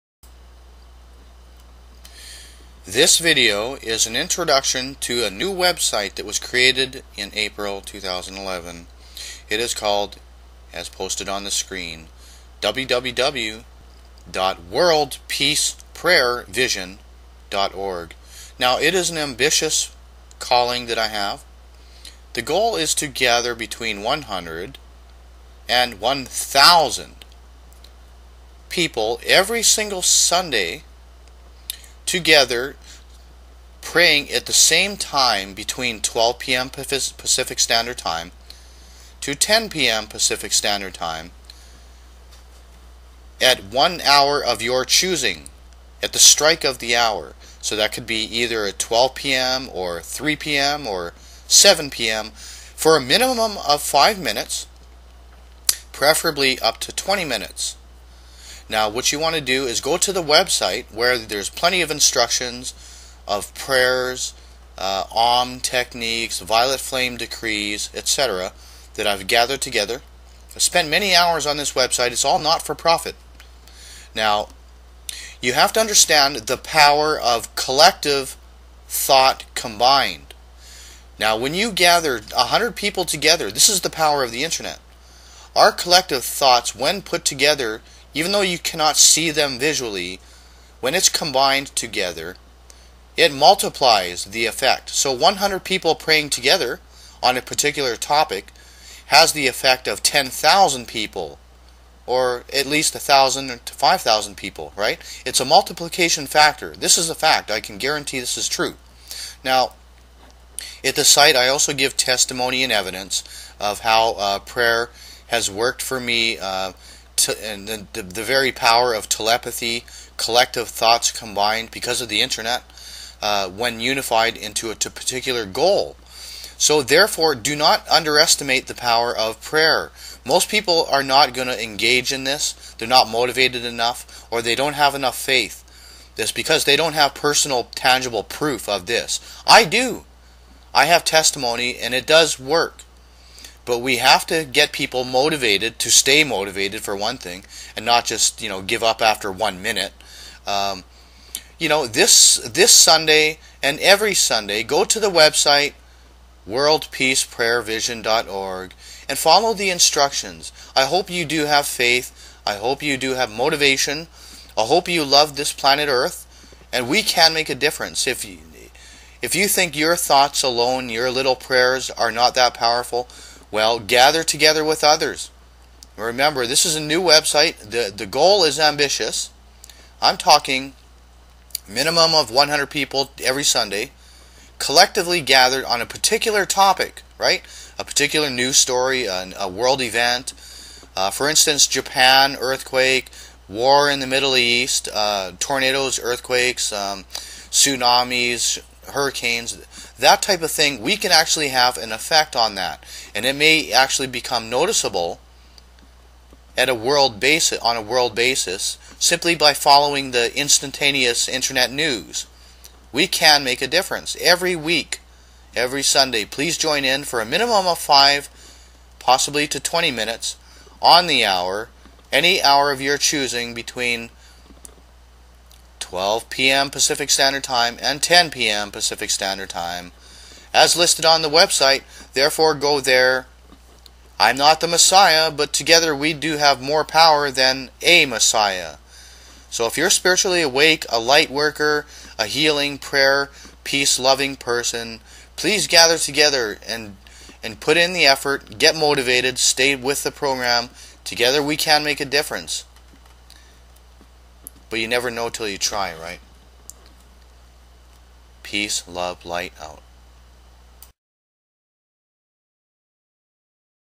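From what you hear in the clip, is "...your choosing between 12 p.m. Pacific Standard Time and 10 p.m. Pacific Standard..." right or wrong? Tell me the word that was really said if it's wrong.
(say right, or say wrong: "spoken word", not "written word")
right.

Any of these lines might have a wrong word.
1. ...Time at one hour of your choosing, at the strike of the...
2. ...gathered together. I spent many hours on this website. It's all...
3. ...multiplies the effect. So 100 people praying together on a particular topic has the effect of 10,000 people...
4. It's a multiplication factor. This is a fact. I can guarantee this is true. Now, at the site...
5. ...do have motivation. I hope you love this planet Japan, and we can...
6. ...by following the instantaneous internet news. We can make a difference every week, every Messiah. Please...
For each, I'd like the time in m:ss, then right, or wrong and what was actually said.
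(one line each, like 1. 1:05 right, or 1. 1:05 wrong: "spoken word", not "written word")
1. 0:40 right
2. 1:09 right
3. 1:33 right
4. 1:45 right
5. 2:42 wrong: "Earth", not "Japan"
6. 3:29 wrong: "Sunday", not "Messiah".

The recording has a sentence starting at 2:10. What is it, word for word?
Most people are not going to engage in this.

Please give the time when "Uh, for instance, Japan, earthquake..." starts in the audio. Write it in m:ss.
3:10.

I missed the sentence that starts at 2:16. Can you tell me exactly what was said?
This because they don't have personal, tangible proof of this.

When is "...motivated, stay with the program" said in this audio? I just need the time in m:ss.
4:08.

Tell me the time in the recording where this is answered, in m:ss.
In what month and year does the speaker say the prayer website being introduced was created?
0:07.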